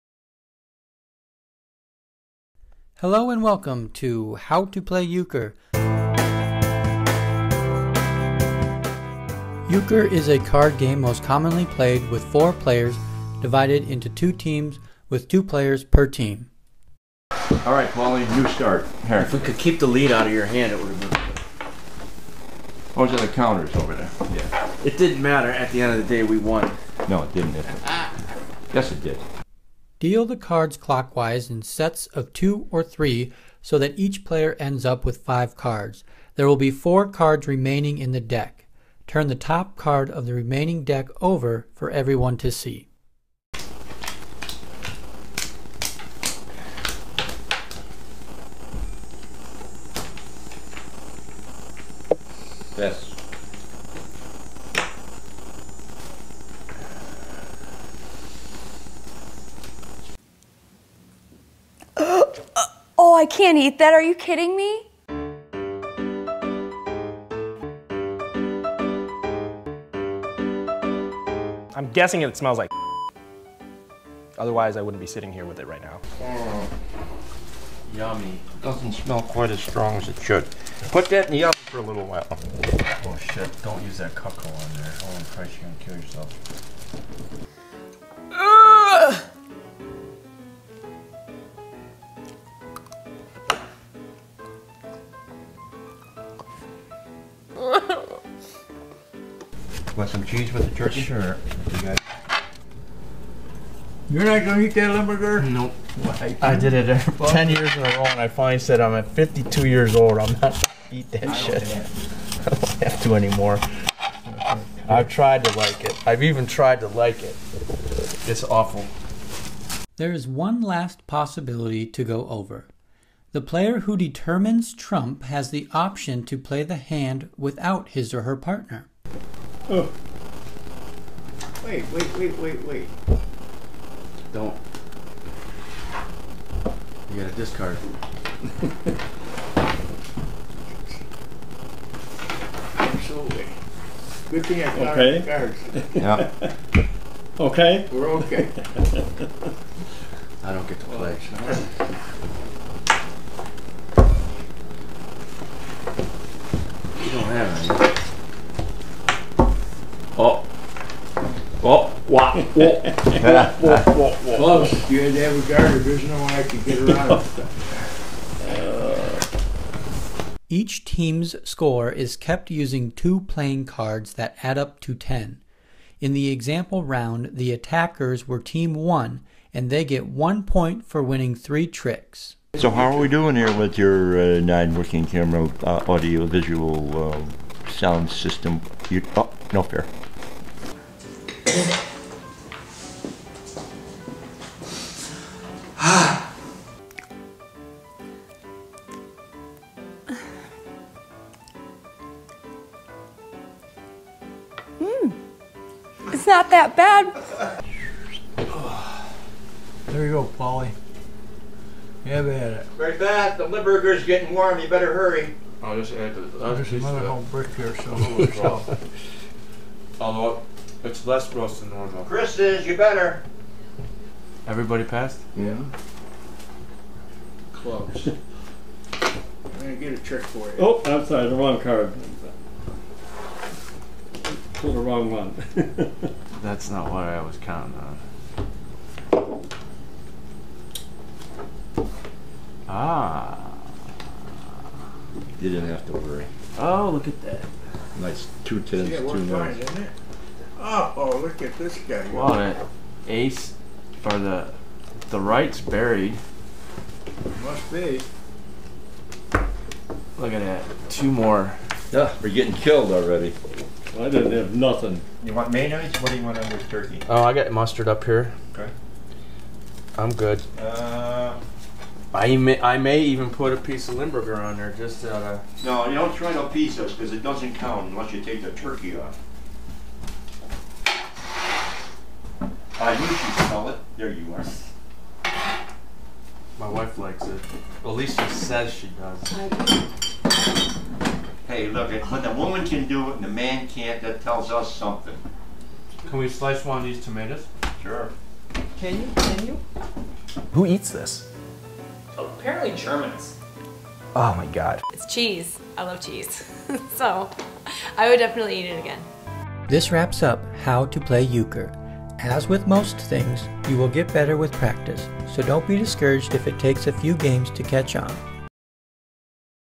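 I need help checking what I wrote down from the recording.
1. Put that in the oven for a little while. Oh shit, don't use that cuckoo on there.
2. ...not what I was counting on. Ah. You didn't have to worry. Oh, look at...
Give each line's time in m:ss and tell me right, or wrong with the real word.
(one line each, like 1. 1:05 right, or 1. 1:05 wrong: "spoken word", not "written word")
1. 1:20 right
2. 3:56 right.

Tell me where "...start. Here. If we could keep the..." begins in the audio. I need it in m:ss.
0:18.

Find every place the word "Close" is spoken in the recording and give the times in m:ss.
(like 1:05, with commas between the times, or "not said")
2:42, 3:47.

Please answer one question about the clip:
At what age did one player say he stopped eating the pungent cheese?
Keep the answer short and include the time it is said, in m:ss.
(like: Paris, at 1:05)
52, at 1:49.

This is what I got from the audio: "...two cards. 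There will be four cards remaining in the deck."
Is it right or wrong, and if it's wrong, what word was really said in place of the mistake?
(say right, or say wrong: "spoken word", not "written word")
wrong: "five", not "two".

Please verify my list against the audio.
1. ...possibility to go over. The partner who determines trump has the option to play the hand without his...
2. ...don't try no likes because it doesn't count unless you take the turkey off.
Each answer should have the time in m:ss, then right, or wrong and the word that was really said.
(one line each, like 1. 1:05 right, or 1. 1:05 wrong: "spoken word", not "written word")
1. 2:01 wrong: "player", not "partner"
2. 4:35 wrong: "pieces", not "likes".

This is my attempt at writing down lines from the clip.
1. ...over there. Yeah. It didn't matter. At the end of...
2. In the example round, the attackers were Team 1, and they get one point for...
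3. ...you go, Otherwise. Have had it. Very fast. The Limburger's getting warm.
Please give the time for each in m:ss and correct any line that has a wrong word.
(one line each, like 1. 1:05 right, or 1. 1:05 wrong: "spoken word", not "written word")
1. 0:23 right
2. 2:56 right
3. 3:30 wrong: "Polly", not "Otherwise".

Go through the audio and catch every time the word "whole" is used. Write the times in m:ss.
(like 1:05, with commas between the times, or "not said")
3:36.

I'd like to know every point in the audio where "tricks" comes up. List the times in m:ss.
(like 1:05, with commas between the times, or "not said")
3:01, 3:49.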